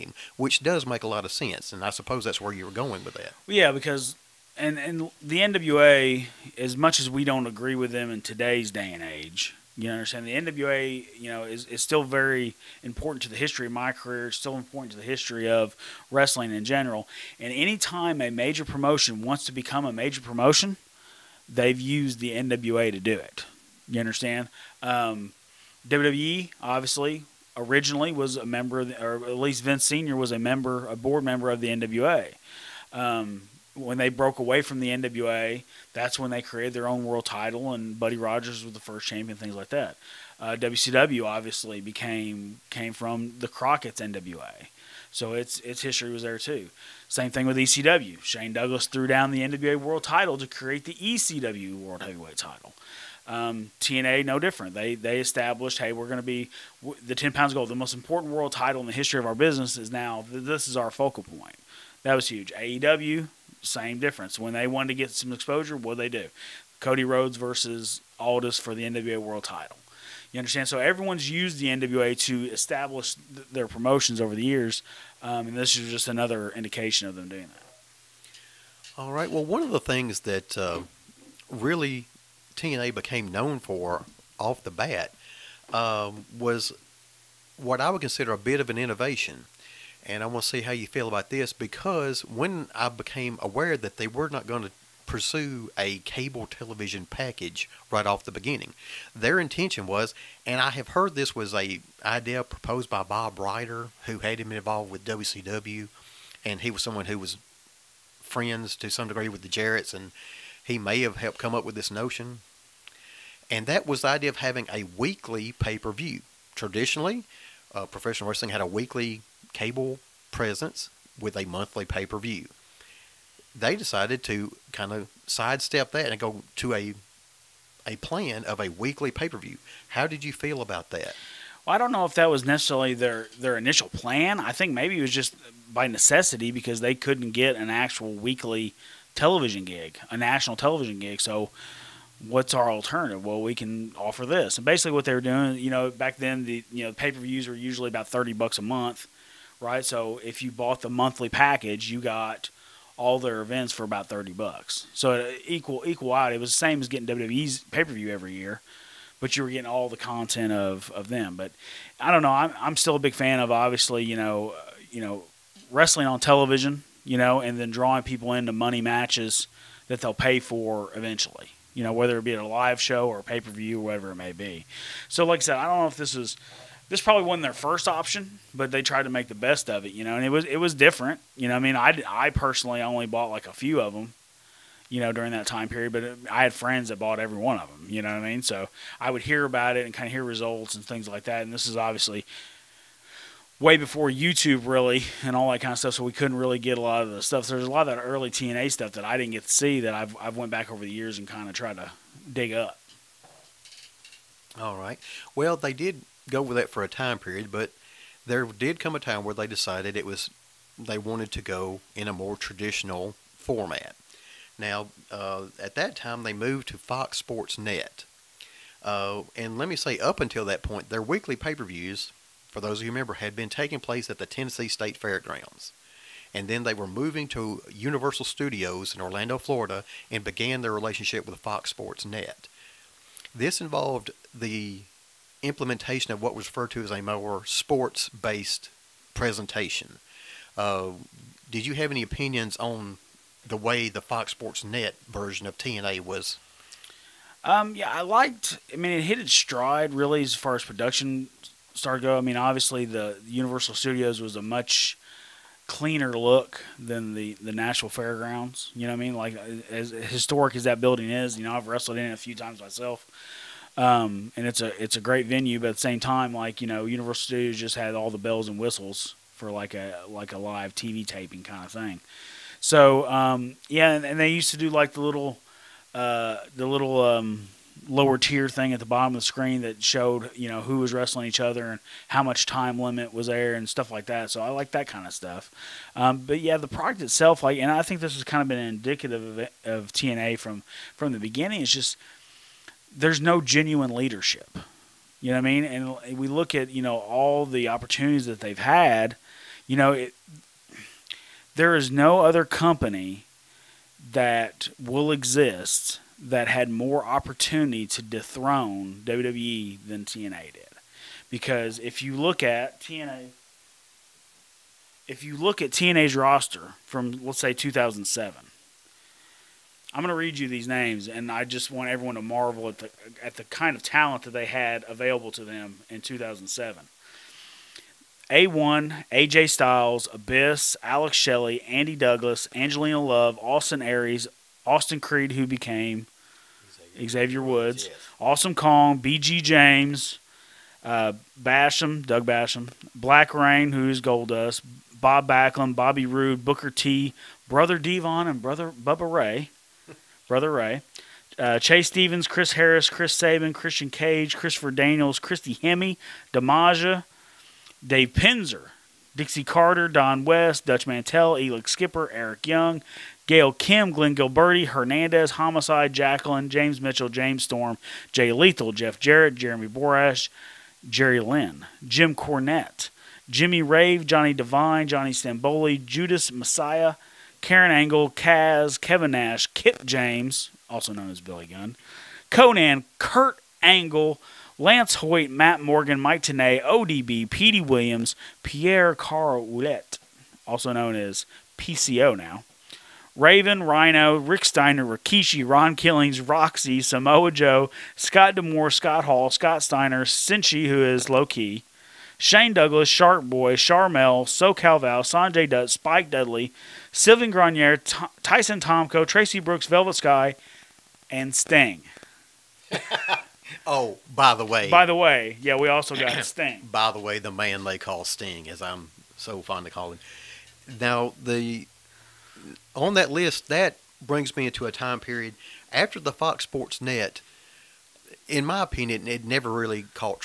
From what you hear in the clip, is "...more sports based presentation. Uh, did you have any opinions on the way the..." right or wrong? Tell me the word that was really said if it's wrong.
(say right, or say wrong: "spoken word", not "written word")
right.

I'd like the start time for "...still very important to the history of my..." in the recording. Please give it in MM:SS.
00:11.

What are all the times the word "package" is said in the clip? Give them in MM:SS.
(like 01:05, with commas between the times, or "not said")
01:37, 02:31.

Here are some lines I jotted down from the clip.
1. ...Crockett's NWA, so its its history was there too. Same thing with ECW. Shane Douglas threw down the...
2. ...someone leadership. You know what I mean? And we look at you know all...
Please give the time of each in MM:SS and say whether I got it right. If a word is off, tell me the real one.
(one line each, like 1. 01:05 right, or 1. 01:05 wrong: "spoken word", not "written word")
1. 00:43 right
2. 04:53 wrong: "genuine", not "someone".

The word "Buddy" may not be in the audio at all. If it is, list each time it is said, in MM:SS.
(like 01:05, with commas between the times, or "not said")
00:37.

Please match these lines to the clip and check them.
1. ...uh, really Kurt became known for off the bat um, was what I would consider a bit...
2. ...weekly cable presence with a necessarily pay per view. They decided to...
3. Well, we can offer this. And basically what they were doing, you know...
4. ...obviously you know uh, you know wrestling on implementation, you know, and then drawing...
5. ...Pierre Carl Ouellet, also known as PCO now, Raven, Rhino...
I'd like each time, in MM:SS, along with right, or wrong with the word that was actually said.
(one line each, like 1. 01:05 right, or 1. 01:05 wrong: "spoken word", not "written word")
1. 01:20 wrong: "TNA", not "Kurt"
2. 01:58 wrong: "monthly", not "necessarily"
3. 02:23 right
4. 02:43 wrong: "television", not "implementation"
5. 06:28 right.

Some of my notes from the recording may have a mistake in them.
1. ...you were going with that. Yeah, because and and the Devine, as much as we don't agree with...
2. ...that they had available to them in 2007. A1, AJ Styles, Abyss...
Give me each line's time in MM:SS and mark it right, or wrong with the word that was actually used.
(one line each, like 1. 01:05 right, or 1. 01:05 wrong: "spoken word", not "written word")
1. 00:02 wrong: "NWA", not "Devine"
2. 05:24 right.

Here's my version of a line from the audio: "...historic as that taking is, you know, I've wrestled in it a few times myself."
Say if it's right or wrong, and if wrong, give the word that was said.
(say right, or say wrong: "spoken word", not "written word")
wrong: "building", not "taking".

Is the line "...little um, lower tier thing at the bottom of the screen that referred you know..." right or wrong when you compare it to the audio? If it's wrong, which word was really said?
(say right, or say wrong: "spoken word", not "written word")
wrong: "showed", not "referred".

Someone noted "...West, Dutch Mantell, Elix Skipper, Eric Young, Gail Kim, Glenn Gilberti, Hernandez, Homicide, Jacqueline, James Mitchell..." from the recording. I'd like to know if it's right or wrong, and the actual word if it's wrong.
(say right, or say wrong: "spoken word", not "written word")
right.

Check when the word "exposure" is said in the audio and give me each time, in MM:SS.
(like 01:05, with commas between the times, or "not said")
01:05.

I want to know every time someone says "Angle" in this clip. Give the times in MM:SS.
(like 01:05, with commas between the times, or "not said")
06:17, 06:23.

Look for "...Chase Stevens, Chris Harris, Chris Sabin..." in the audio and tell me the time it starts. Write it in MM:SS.
05:51.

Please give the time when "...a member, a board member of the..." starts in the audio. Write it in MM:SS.
00:30.